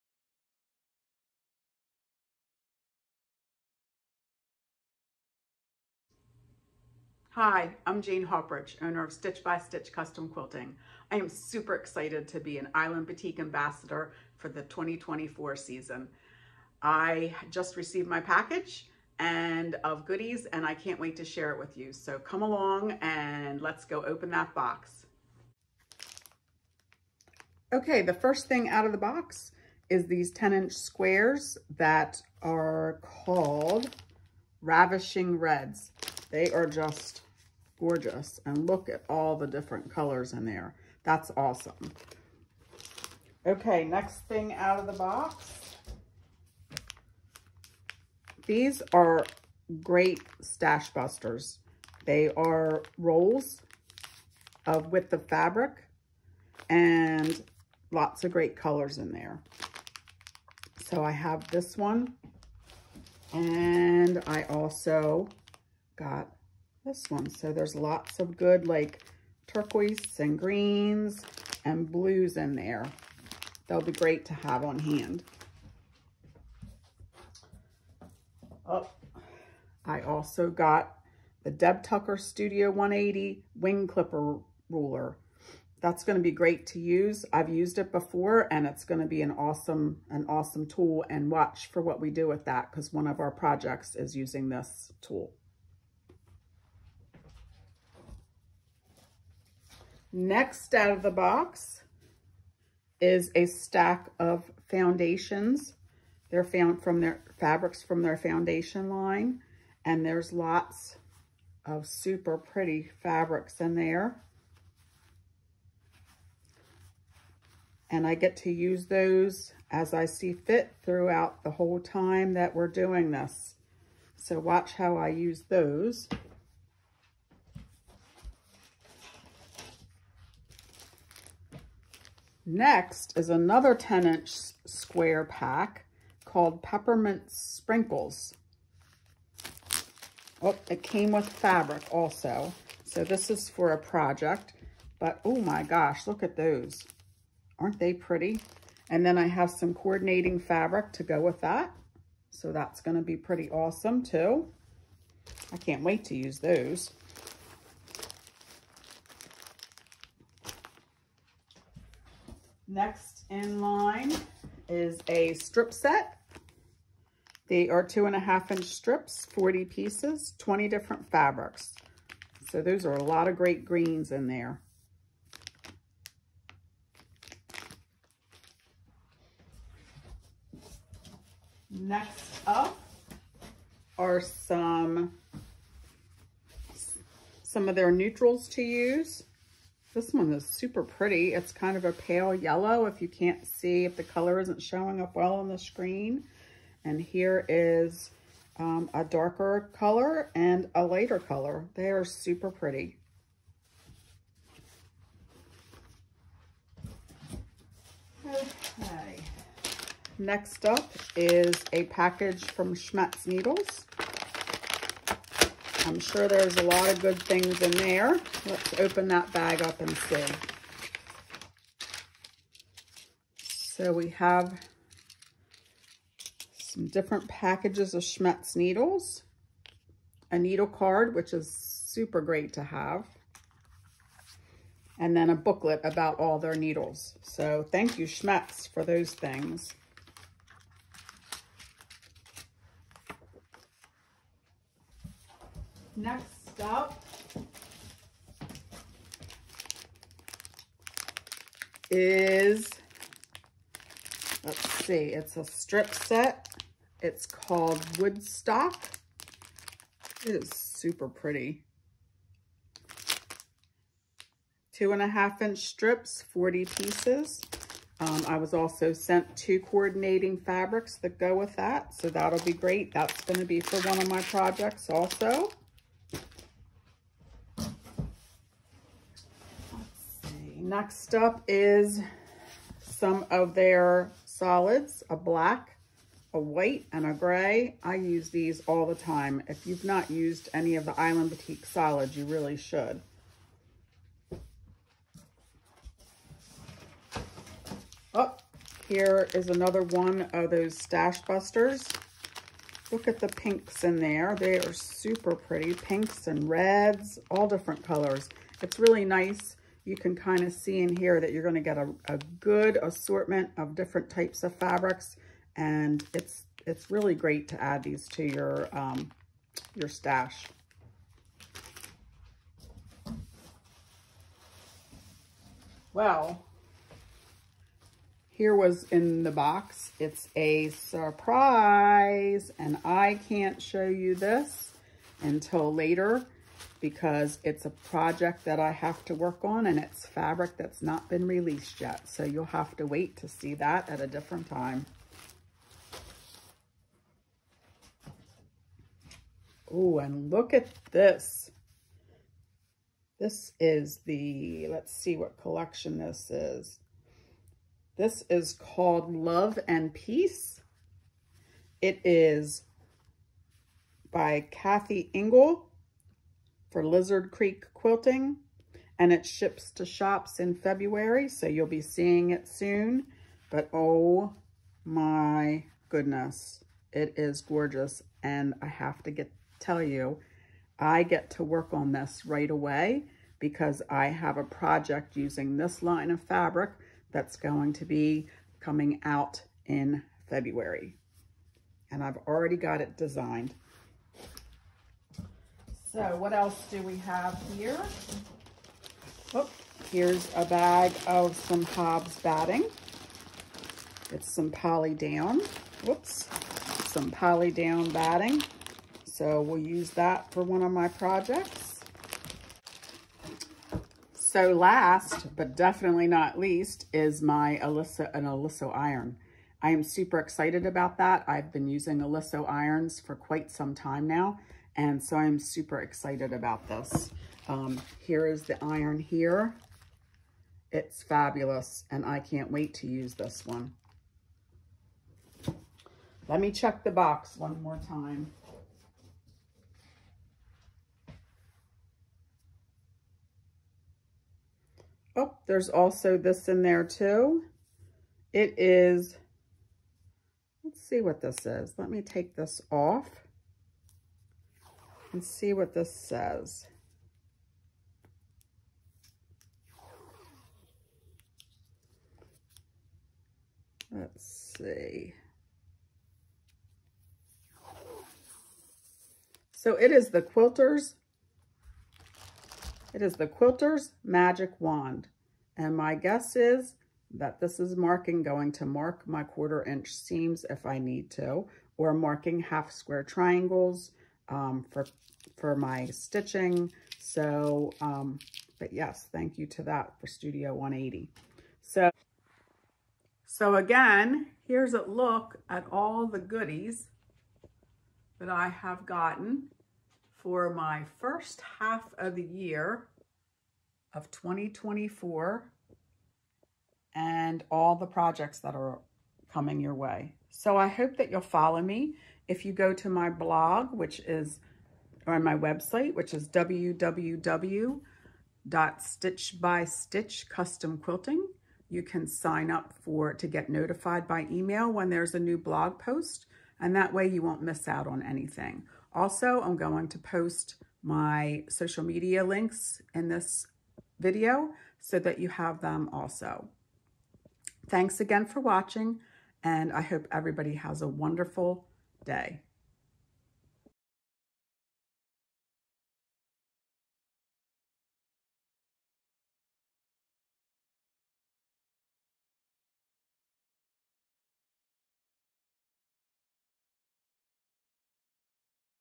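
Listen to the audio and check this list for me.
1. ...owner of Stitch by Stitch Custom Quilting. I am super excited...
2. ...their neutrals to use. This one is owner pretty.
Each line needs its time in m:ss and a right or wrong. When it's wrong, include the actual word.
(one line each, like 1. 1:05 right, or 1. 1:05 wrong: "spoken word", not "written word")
1. 0:08 right
2. 3:07 wrong: "super", not "owner".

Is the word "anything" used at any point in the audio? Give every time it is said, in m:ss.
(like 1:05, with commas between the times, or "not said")
8:48.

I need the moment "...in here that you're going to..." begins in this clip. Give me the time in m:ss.
5:10.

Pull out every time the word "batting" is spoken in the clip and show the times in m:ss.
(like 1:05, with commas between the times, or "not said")
6:42, 6:47.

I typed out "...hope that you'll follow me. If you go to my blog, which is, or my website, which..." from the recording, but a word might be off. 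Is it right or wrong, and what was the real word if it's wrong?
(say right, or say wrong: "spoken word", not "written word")
right.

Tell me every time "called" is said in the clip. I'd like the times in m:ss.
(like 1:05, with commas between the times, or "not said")
0:33, 2:16, 4:17, 5:58.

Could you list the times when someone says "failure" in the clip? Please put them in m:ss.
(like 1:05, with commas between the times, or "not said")
not said.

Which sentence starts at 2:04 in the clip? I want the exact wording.
So watch how I use those.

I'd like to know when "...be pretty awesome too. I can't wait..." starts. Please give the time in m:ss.
2:33.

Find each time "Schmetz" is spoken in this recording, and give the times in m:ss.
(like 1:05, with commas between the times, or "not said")
3:32, 3:48, 3:58.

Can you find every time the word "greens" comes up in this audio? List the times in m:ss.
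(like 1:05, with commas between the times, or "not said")
1:10, 2:53.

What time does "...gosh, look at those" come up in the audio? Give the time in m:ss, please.
2:25.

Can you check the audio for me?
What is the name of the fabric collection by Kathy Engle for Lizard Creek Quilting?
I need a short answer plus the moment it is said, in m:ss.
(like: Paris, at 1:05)
Love and Peace, at 5:59.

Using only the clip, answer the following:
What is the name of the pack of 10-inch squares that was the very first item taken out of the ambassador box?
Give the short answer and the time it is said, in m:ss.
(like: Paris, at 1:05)
Ravishing Reds, at 0:34.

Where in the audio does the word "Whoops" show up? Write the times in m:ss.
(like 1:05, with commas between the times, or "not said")
6:45.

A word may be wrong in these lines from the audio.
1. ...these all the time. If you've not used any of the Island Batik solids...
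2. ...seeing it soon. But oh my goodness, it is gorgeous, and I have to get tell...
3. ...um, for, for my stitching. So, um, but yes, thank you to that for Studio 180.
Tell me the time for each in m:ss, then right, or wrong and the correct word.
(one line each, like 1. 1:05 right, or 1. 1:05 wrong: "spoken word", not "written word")
1. 4:48 right
2. 6:11 right
3. 8:04 right.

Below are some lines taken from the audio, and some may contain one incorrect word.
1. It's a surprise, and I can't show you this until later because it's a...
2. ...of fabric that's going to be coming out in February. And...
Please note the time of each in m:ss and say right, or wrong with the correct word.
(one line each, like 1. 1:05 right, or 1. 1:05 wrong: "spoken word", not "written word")
1. 5:29 right
2. 6:26 right.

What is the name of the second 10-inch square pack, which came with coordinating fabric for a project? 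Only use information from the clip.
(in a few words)
Peppermint Sprinkles.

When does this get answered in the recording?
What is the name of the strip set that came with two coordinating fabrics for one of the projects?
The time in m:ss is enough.
4:17.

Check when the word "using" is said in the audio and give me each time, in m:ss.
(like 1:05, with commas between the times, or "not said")
1:34, 6:25, 7:01.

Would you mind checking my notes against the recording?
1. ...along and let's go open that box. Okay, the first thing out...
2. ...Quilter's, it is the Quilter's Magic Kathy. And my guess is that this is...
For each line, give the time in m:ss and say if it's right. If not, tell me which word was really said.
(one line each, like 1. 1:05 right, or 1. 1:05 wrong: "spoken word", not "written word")
1. 0:22 right
2. 7:50 wrong: "Wand", not "Kathy".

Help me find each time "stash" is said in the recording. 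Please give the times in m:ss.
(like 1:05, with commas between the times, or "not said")
0:50, 5:00, 5:19.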